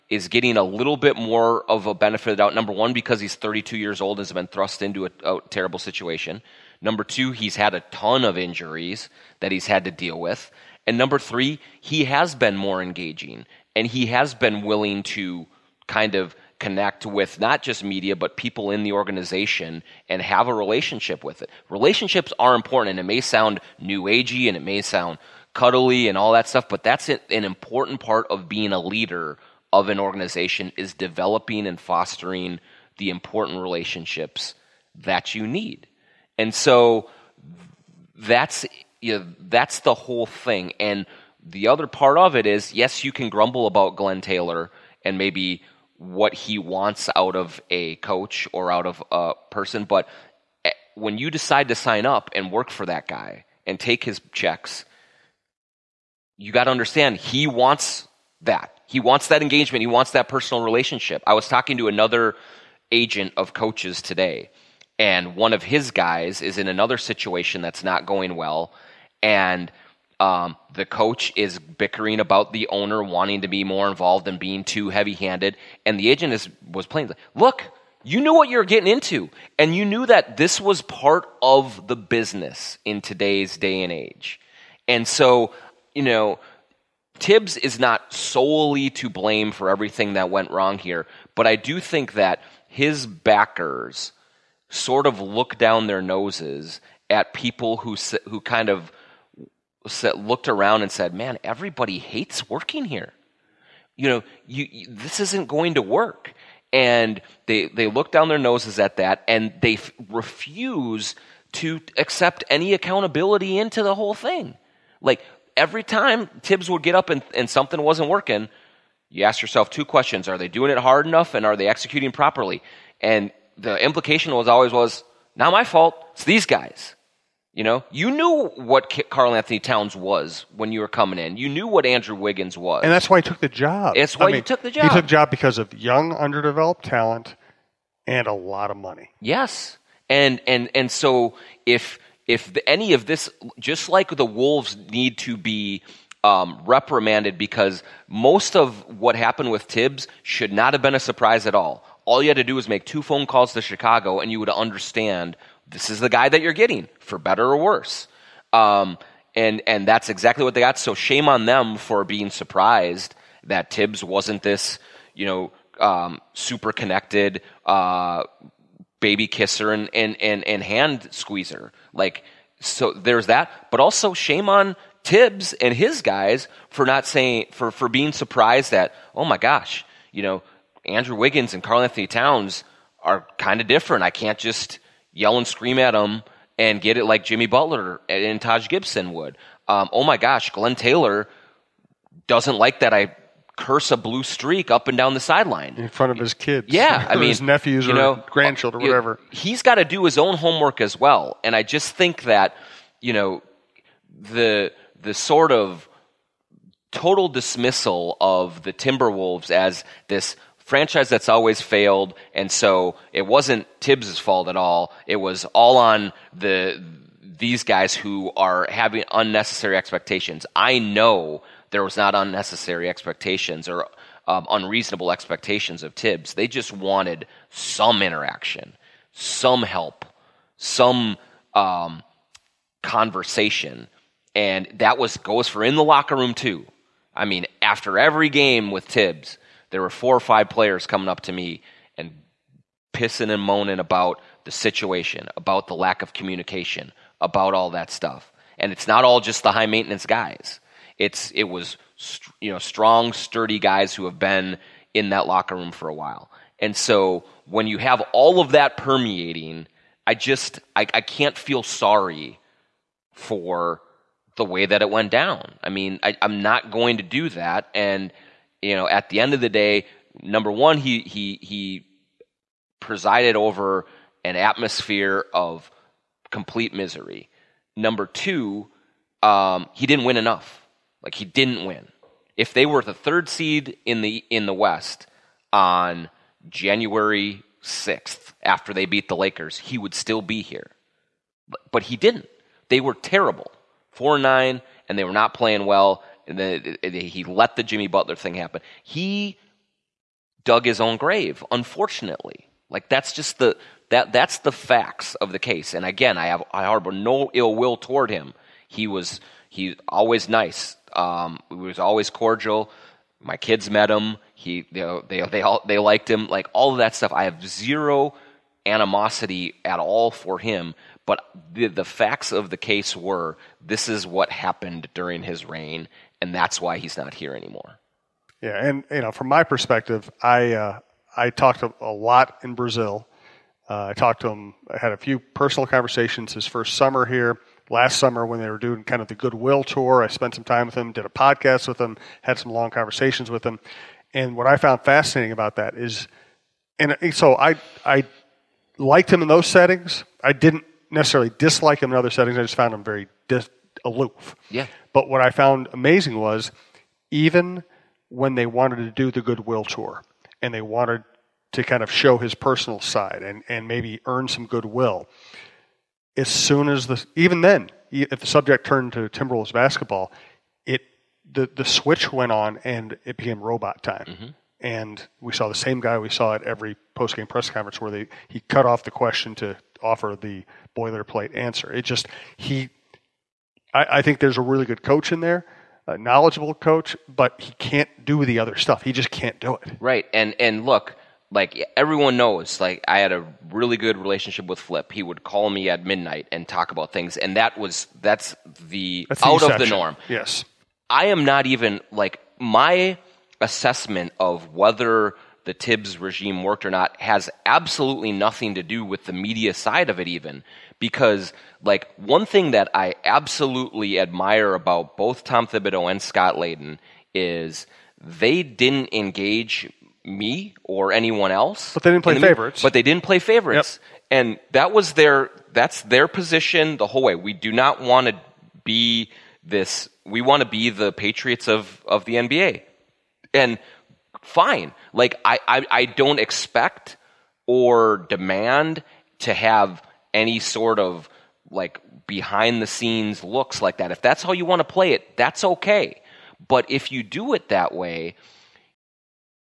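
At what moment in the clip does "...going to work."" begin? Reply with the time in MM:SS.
01:45.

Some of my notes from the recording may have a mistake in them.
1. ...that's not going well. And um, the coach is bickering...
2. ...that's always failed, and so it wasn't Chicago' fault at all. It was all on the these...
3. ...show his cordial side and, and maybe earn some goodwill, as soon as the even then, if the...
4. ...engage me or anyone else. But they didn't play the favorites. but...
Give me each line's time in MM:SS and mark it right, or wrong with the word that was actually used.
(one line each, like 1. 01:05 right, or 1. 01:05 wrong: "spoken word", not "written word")
1. 01:07 right
2. 03:31 wrong: "Thibs", not "Chicago"
3. 06:01 wrong: "personal", not "cordial"
4. 06:58 right.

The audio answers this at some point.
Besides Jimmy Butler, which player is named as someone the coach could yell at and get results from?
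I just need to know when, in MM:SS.
03:08.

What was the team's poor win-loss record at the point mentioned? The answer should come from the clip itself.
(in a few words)
4-9.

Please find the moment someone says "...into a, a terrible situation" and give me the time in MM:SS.
00:04.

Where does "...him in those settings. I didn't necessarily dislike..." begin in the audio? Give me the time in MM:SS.
05:49.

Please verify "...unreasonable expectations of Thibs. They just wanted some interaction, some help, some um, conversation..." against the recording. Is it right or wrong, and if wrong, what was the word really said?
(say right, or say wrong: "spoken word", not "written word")
right.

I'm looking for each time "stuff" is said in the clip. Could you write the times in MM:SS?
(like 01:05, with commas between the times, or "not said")
00:26, 04:07, 05:16, 06:28.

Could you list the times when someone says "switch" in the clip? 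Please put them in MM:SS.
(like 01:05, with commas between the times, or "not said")
06:11.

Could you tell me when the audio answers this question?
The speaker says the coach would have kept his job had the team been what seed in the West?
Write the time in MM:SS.
04:42.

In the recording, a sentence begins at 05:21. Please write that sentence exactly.
But the, the facts of the case were this is what happened during his reign, and that's why he's not here anymore.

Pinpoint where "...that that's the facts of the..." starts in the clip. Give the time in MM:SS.
05:03.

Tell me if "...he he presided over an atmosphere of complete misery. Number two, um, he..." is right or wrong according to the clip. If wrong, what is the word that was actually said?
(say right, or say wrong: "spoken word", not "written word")
right.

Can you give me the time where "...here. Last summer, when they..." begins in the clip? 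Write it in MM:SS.
05:37.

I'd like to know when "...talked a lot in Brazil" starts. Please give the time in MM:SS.
05:31.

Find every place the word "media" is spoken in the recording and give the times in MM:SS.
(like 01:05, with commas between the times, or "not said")
00:17, 06:49.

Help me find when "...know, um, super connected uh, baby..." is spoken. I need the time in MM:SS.
02:45.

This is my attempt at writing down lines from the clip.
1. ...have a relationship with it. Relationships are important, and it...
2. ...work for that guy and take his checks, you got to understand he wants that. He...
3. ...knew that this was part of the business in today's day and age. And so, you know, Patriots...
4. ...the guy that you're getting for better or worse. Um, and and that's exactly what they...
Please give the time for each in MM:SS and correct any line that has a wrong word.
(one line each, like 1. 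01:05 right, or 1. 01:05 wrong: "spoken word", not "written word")
1. 00:20 right
2. 00:52 right
3. 01:19 wrong: "Thibs", not "Patriots"
4. 02:35 right.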